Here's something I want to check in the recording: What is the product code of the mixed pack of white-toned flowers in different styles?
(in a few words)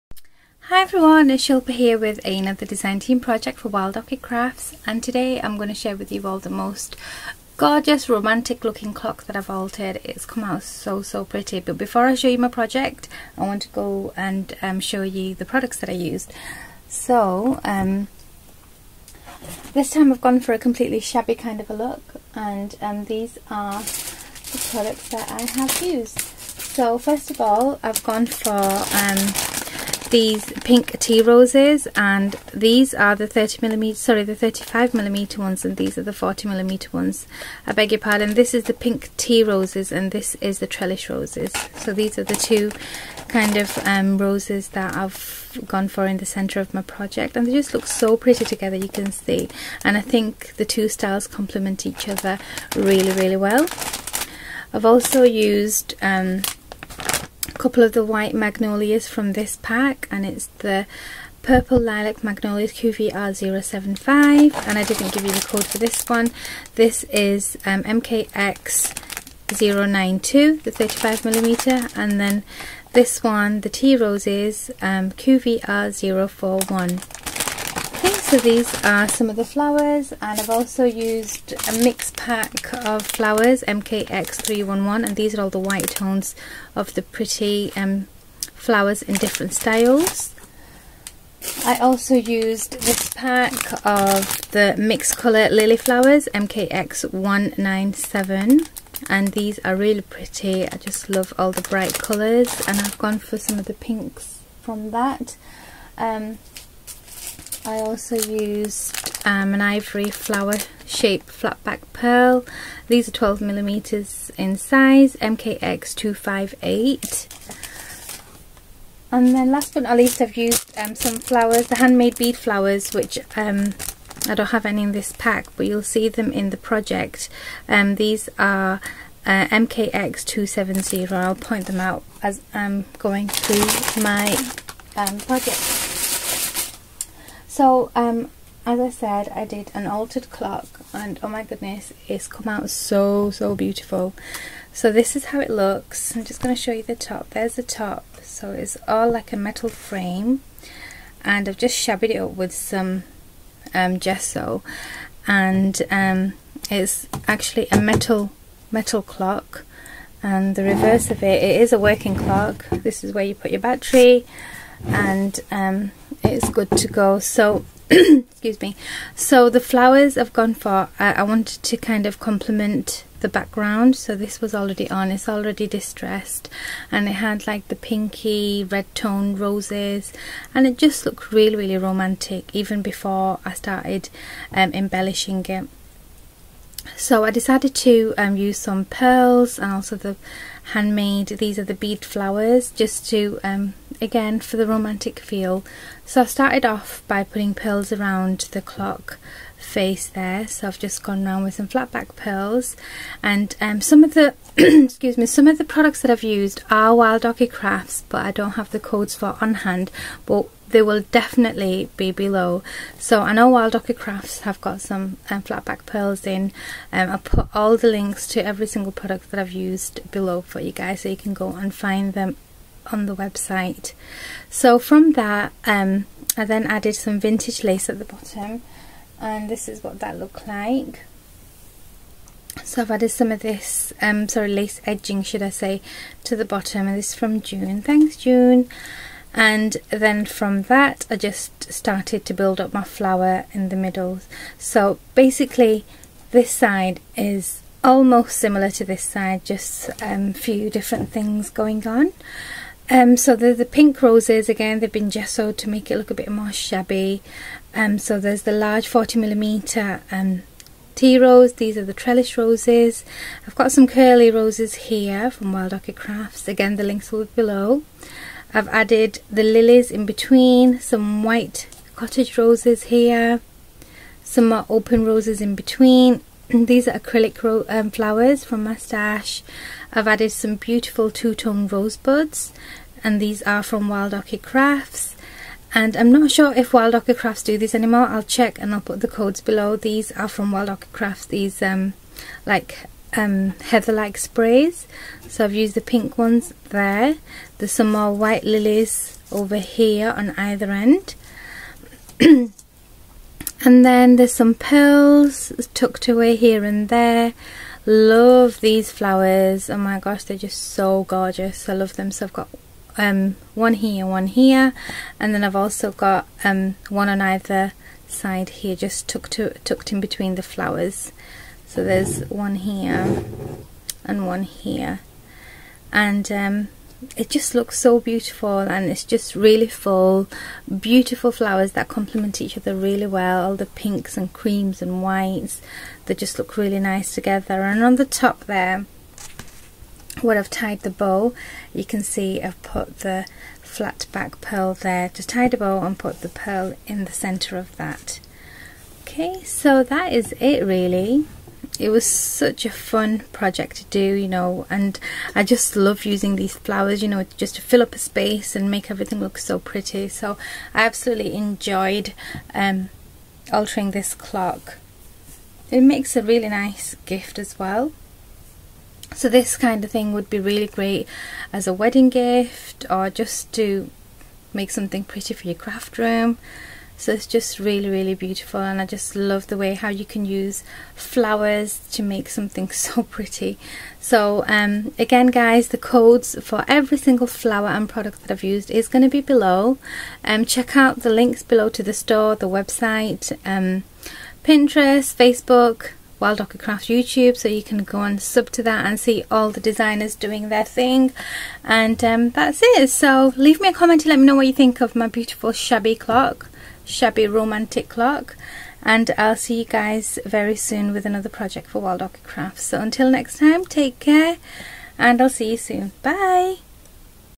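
MKX311.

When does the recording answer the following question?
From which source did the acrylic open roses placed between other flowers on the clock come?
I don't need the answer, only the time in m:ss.
4:38.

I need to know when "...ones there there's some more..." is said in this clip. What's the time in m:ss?
4:56.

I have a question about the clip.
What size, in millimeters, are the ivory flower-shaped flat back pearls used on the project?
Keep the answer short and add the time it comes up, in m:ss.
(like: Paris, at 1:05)
12 millimeters, at 1:53.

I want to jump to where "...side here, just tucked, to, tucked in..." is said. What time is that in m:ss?
5:18.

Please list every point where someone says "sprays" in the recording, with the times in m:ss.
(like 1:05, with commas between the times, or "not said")
4:54.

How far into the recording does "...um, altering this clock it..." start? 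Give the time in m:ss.
6:02.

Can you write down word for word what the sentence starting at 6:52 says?
So until next time, take care and I'll see you soon.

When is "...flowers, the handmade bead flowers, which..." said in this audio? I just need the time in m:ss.
2:01.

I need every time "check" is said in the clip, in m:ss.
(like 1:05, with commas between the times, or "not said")
4:48, 6:30.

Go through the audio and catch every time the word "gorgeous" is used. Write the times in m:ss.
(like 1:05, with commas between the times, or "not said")
0:07, 5:11.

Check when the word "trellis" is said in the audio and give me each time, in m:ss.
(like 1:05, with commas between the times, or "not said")
0:40, 4:21.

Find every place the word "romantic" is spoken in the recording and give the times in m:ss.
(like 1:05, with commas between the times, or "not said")
0:08, 3:01, 3:14, 6:47.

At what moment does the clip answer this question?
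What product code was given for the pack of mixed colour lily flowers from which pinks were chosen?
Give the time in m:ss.
1:36.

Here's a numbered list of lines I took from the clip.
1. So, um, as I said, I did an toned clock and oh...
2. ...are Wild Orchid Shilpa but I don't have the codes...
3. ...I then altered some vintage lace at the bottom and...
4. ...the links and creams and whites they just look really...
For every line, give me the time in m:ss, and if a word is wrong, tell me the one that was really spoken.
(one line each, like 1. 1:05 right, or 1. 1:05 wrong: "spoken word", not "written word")
1. 2:17 wrong: "altered", not "toned"
2. 3:26 wrong: "Crafts", not "Shilpa"
3. 3:46 wrong: "added", not "altered"
4. 5:33 wrong: "pinks", not "links".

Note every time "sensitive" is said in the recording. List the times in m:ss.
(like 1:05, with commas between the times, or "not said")
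not said.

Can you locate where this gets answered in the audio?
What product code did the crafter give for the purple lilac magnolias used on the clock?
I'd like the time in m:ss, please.
1:02.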